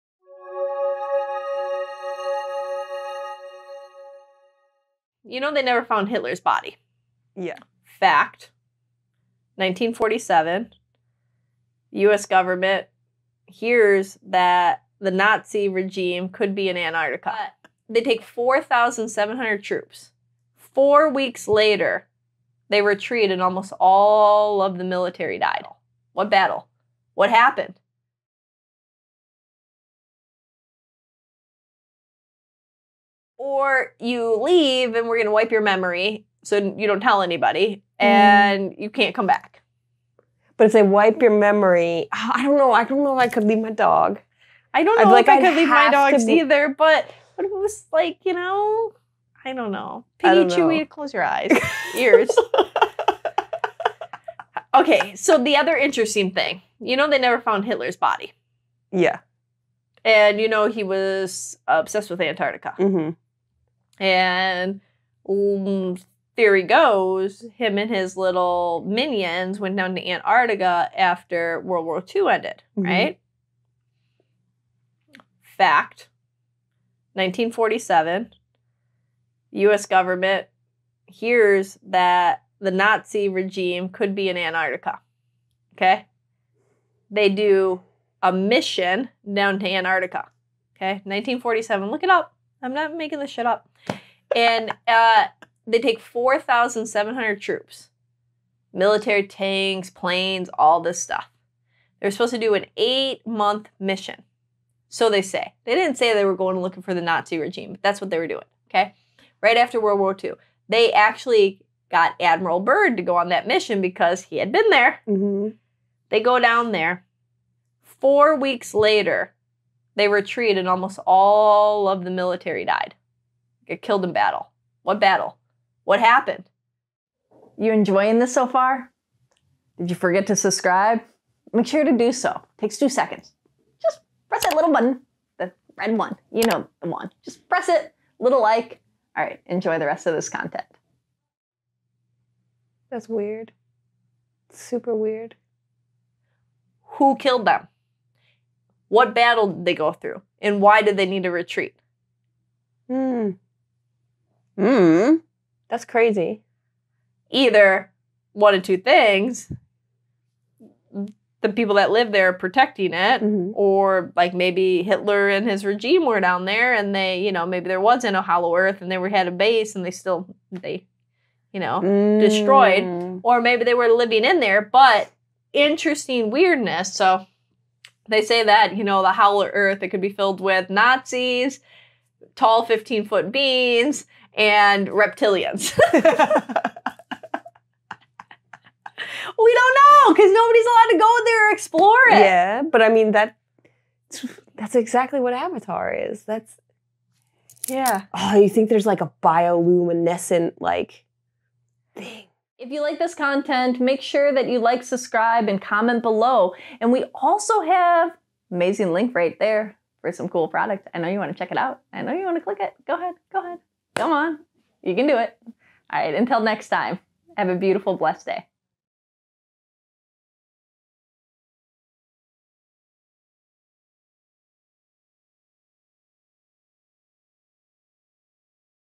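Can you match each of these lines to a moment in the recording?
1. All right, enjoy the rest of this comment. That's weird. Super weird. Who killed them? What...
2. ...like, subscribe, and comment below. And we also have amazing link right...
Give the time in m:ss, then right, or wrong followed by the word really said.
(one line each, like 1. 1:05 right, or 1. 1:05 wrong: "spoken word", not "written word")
1. 2:19 wrong: "content", not "comment"
2. 3:24 right.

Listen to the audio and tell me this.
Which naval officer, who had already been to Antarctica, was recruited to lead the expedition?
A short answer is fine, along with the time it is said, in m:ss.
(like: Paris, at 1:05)
Admiral Byrd, at 1:52.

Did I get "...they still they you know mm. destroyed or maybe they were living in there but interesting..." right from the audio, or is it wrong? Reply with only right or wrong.
right.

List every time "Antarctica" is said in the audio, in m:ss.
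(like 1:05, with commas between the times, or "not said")
0:16, 1:02, 1:10, 1:24, 1:29.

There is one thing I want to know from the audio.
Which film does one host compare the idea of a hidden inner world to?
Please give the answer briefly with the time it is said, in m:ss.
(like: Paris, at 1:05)
Avatar, at 3:15.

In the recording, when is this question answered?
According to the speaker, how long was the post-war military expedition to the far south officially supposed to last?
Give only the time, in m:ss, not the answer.
1:42.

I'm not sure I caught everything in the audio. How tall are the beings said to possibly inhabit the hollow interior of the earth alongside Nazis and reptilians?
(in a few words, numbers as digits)
15 feet.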